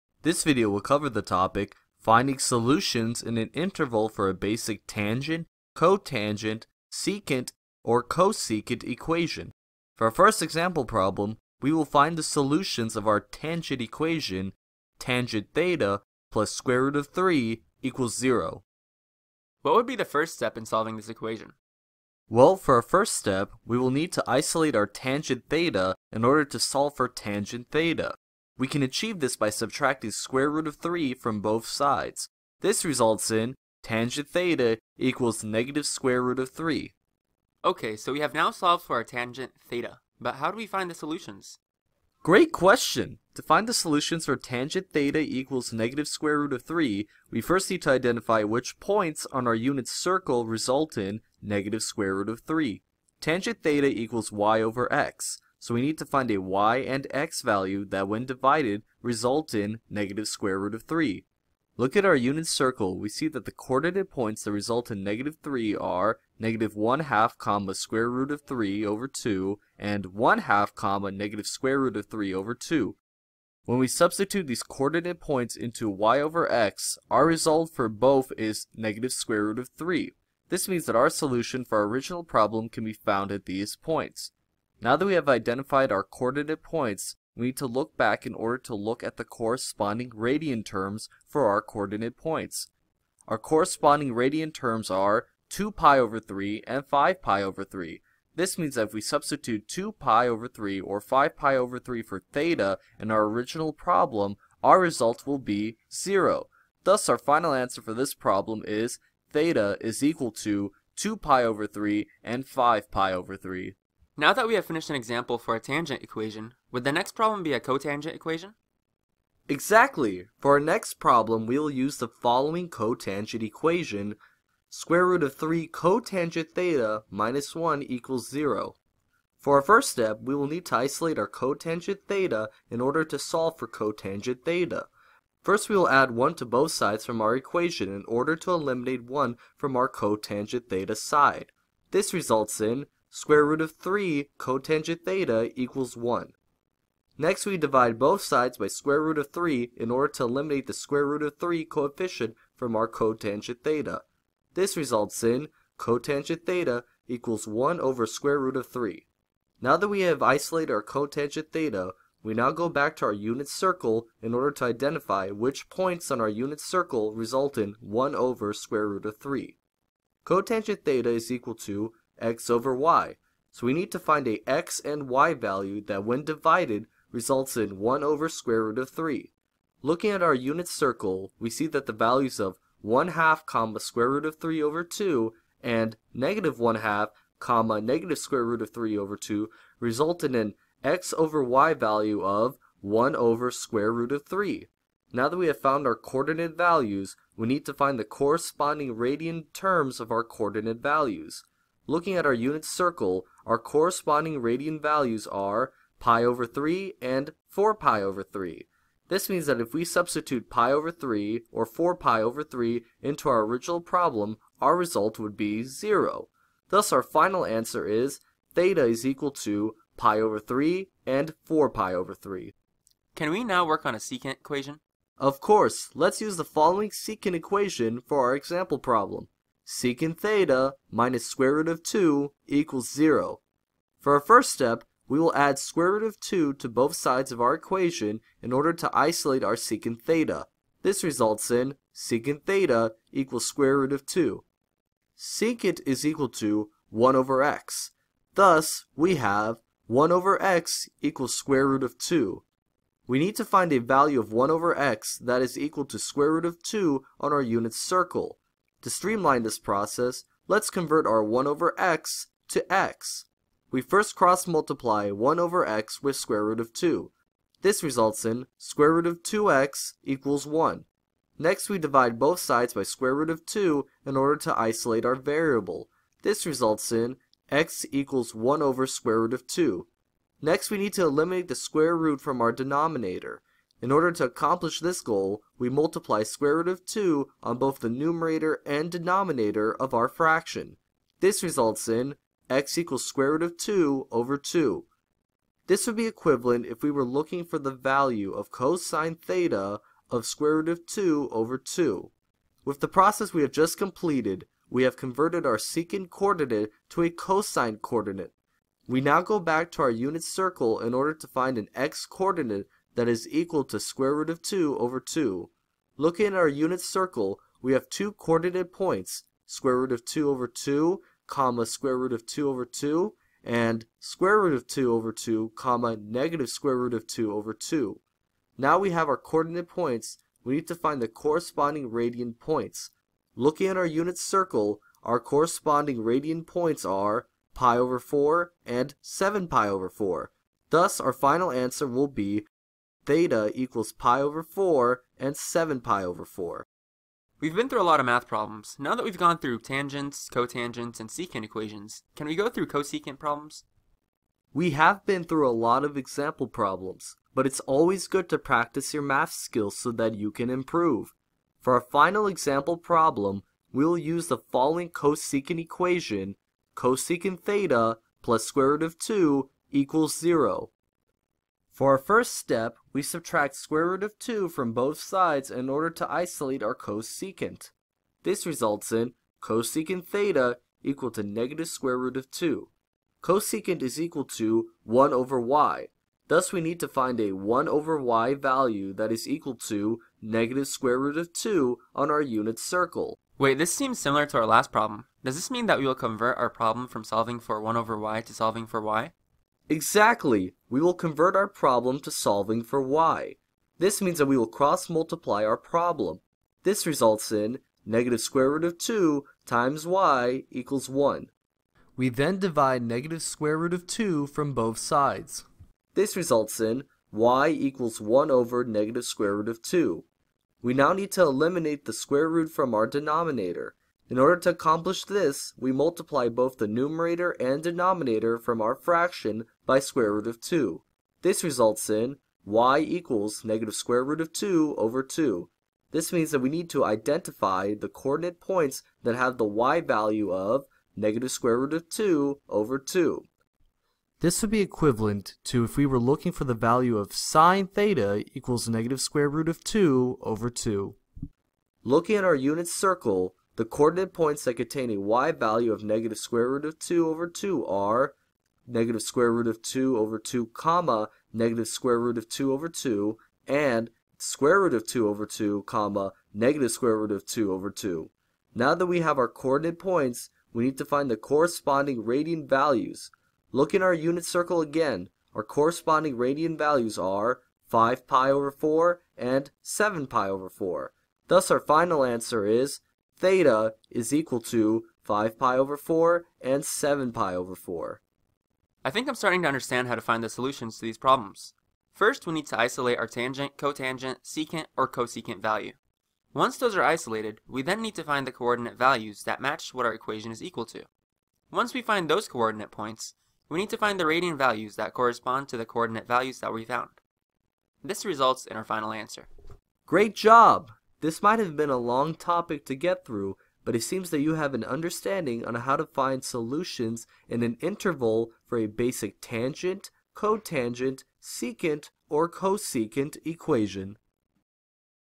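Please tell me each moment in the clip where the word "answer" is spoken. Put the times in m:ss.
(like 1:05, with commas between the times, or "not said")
1:47, 3:37, 5:41, 8:02, 8:28.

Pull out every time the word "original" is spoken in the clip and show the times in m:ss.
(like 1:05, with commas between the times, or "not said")
1:21, 1:43, 3:33.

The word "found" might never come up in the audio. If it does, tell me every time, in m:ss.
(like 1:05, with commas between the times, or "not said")
1:22, 3:15, 8:26.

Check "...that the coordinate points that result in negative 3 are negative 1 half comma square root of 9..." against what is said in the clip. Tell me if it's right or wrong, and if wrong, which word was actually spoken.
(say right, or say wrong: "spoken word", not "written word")
wrong: "3", not "9".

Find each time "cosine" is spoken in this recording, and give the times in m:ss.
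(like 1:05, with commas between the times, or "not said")
4:58, 5:07.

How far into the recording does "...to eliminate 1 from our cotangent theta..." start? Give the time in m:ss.
2:18.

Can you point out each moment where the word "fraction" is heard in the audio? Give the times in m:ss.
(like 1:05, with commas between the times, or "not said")
4:50, 7:08.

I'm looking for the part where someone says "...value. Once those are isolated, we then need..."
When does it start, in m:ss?
8:15.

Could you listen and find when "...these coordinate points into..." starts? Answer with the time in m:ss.
1:14.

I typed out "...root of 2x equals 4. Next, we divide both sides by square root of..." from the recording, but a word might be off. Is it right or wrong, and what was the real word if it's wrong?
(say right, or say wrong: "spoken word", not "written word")
wrong: "1", not "4".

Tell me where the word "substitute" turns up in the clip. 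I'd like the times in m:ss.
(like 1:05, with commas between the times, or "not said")
1:13, 1:39, 3:29.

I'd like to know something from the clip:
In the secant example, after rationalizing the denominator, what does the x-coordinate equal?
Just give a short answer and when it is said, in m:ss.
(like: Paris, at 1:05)
√2/2, at 4:52.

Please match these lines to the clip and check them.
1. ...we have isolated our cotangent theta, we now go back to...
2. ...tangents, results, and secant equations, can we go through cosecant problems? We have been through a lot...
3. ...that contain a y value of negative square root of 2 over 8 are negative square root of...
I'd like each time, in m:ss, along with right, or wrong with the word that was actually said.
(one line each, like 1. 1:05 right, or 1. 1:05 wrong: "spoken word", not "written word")
1. 2:39 right
2. 5:49 wrong: "cotangents", not "results"
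3. 7:34 wrong: "2", not "8".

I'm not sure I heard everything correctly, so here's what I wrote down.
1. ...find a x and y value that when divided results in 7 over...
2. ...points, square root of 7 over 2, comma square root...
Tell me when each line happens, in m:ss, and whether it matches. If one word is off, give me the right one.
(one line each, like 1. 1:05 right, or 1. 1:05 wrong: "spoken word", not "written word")
1. 2:53 wrong: "1", not "7"
2. 5:18 wrong: "2", not "7".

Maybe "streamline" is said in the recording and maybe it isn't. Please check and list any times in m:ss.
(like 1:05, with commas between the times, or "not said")
4:18.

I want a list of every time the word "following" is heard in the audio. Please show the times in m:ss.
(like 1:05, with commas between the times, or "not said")
2:02, 3:46, 6:04.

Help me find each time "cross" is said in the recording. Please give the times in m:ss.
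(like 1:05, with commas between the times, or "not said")
4:24, 6:44.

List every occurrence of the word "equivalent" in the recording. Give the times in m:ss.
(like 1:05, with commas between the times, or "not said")
4:56, 7:24.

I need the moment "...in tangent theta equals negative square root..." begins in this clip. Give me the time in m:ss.
0:33.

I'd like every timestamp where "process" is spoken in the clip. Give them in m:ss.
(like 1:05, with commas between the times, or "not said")
4:19, 5:02.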